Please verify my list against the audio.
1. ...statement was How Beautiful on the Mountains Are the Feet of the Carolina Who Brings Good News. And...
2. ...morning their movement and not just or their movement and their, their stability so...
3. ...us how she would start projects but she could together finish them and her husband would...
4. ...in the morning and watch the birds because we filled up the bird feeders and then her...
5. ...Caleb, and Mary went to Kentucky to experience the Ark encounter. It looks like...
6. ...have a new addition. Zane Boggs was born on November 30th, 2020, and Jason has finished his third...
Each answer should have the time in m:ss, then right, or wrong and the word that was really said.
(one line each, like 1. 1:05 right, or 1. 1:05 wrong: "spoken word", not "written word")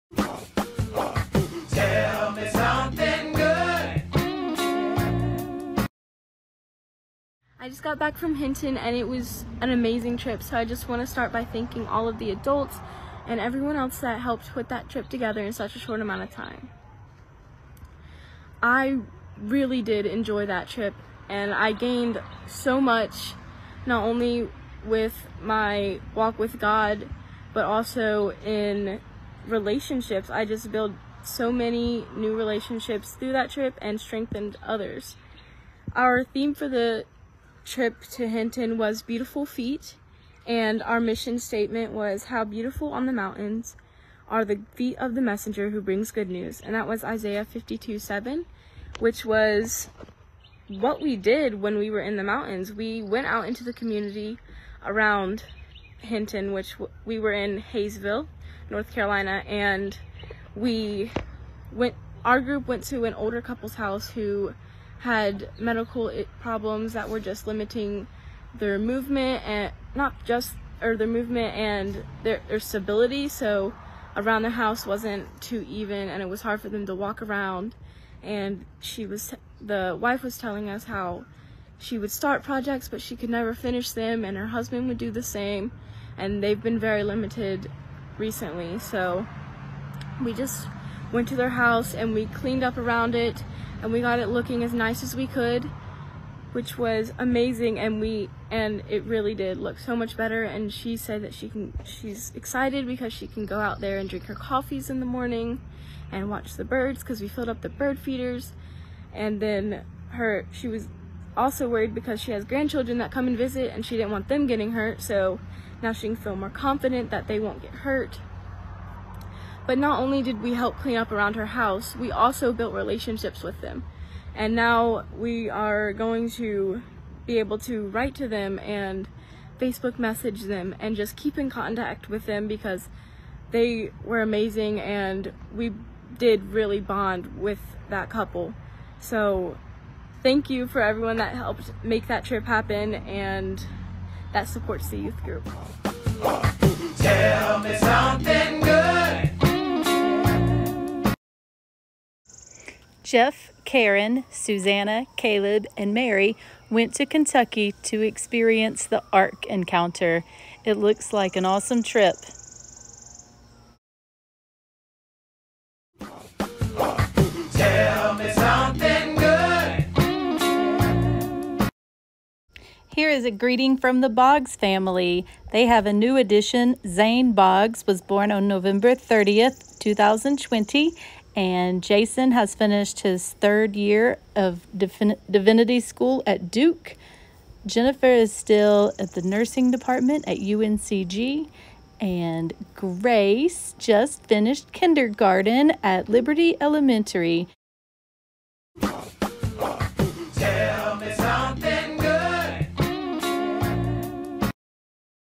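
1. 0:41 wrong: "Messenger", not "Carolina"
2. 1:07 wrong: "limiting", not "morning"
3. 1:20 wrong: "never", not "together"
4. 1:44 right
5. 2:35 right
6. 2:55 right.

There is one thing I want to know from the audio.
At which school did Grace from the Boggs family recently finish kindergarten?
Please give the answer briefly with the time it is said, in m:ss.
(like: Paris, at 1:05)
Liberty Elementary, at 3:16.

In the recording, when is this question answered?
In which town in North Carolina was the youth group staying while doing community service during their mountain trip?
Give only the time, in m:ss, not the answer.
0:57.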